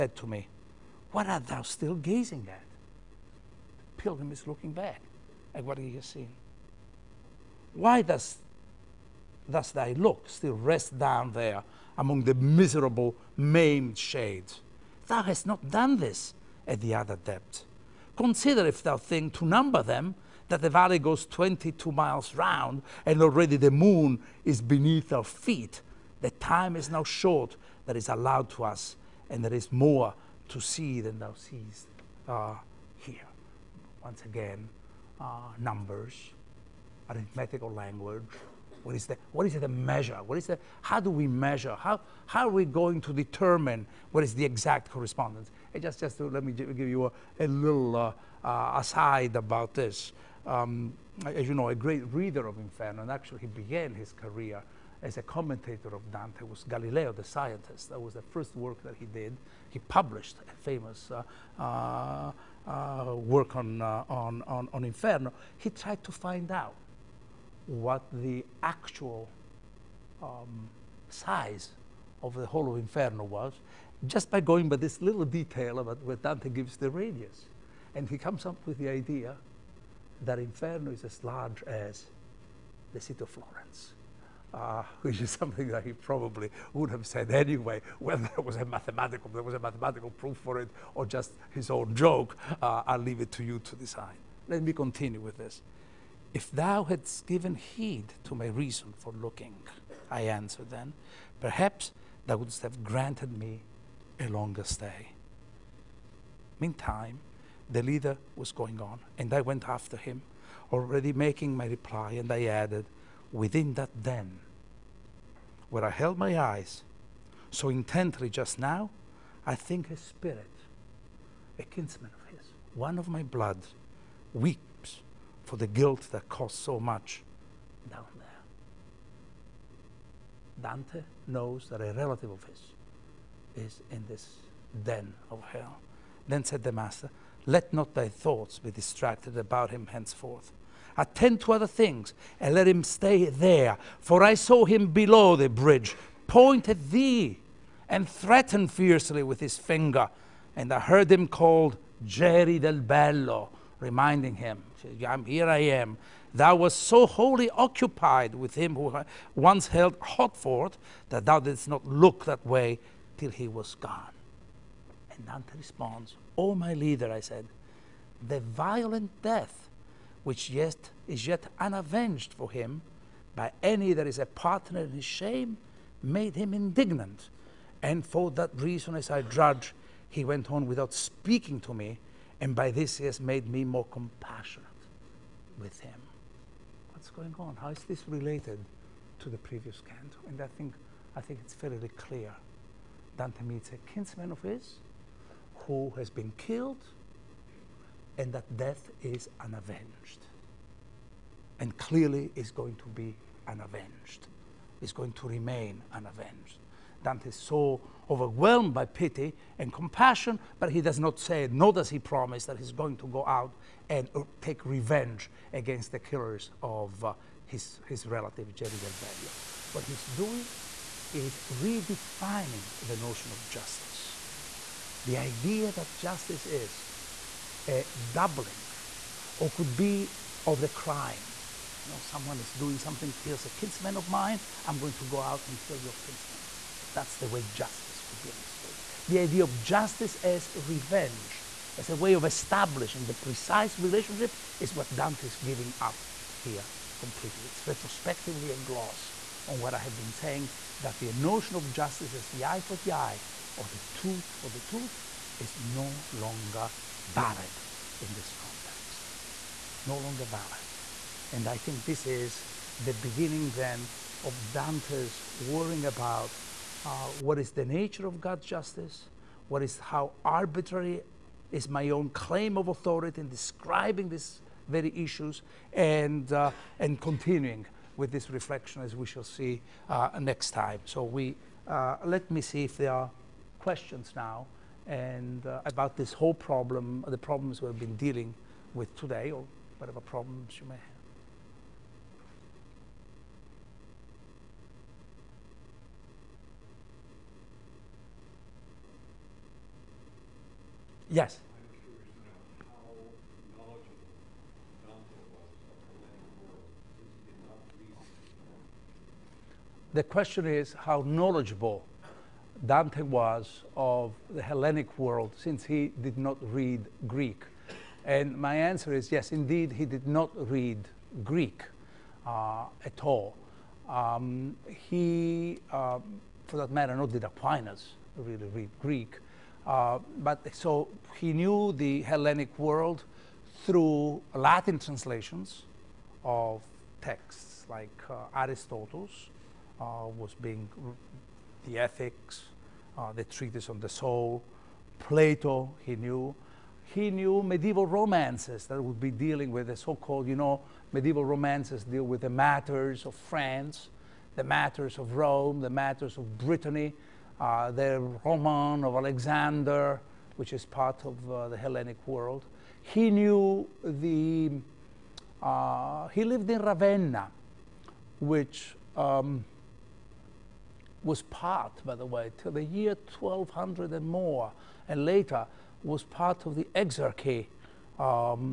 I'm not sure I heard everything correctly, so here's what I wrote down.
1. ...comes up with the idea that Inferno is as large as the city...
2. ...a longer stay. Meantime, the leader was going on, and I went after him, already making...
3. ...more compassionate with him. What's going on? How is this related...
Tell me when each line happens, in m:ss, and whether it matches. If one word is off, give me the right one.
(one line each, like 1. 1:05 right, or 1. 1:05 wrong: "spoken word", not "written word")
1. 1:18 right
2. 1:44 right
3. 3:03 right.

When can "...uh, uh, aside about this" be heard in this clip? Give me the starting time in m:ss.
0:47.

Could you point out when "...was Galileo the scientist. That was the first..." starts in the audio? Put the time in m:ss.
0:56.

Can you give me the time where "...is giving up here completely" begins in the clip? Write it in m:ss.
4:05.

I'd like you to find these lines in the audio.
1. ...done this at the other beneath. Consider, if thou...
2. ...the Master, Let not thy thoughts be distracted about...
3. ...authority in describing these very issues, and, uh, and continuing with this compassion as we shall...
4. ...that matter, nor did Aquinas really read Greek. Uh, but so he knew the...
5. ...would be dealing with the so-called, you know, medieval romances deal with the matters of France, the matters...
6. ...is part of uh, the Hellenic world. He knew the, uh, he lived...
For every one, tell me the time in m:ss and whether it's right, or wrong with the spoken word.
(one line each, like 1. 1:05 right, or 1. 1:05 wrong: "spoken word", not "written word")
1. 0:15 wrong: "depth", not "beneath"
2. 2:16 right
3. 4:32 wrong: "reflection", not "compassion"
4. 5:26 right
5. 5:48 right
6. 6:00 right.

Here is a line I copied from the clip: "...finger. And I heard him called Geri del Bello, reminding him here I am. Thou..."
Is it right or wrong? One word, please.
right.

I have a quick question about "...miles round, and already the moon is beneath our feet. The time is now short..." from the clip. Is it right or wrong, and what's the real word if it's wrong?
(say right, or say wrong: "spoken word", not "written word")
right.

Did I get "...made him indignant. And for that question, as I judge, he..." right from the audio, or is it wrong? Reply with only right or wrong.
wrong.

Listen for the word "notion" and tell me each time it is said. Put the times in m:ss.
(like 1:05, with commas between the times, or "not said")
3:42, 4:11.